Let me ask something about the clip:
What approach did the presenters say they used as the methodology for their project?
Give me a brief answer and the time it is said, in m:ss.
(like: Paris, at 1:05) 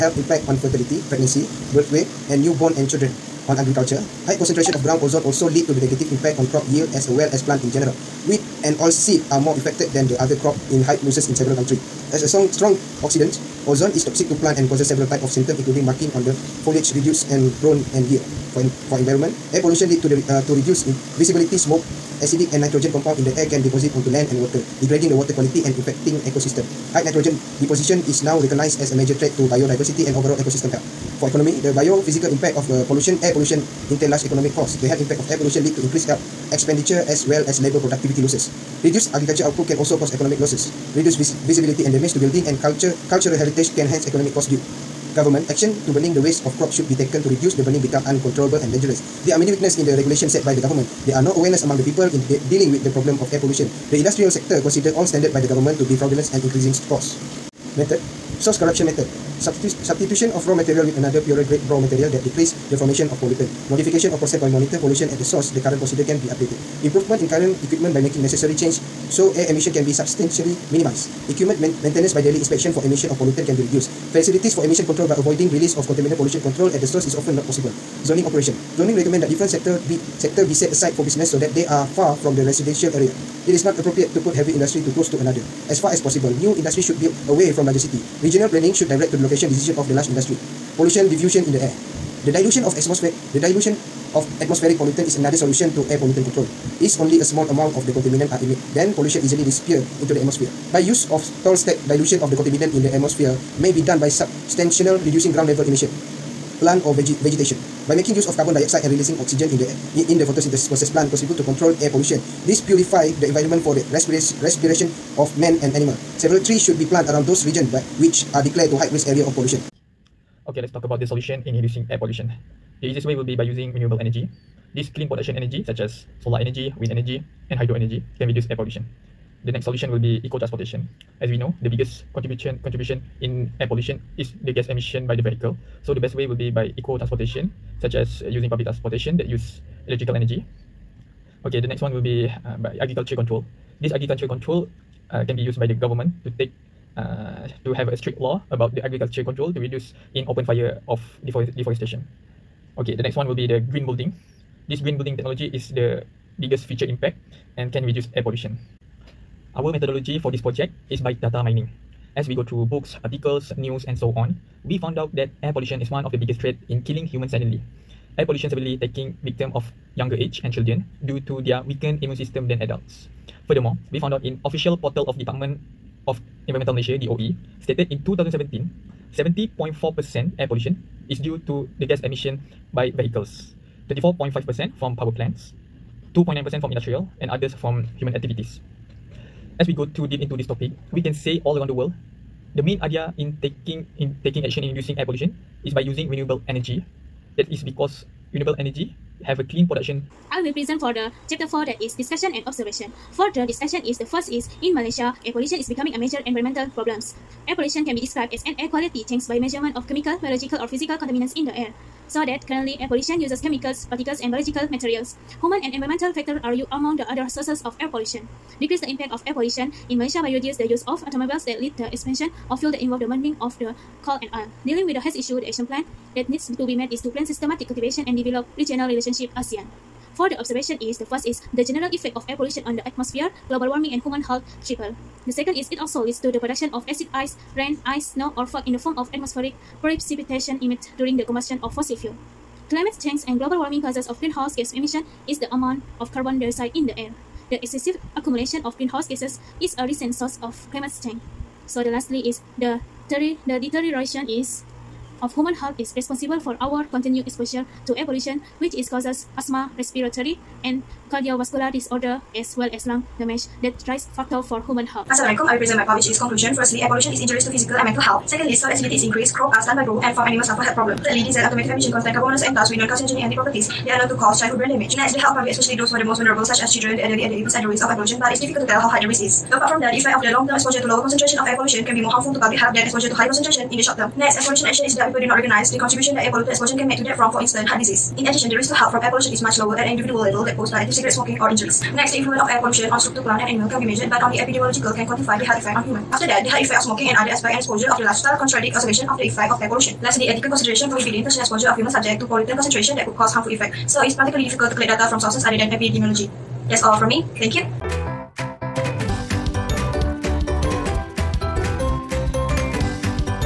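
Data mining, at 2:41.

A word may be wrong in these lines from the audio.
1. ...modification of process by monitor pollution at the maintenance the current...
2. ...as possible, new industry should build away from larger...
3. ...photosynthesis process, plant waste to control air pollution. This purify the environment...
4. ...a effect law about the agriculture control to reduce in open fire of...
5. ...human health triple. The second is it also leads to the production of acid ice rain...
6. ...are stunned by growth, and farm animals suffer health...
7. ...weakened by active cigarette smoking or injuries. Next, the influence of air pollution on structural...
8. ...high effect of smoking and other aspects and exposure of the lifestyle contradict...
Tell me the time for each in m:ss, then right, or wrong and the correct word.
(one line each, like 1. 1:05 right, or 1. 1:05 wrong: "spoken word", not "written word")
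1. 1:03 wrong: "source", not "maintenance"
2. 1:25 right
3. 1:50 wrong: "contribute", not "waste"
4. 2:27 wrong: "strict", not "effect"
5. 3:54 right
6. 4:29 right
7. 4:50 wrong: "posed", not "weakened"
8. 4:56 right.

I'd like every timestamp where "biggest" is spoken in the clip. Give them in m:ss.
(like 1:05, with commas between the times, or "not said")
2:11, 2:36, 2:46.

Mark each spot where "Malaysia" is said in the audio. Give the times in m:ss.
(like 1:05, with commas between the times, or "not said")
2:56, 3:24, 3:39.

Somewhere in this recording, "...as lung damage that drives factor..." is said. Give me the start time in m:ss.
4:22.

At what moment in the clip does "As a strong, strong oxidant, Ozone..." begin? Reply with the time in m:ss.
0:12.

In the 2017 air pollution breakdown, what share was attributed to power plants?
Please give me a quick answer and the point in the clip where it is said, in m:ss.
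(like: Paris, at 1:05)
24.5%, at 3:03.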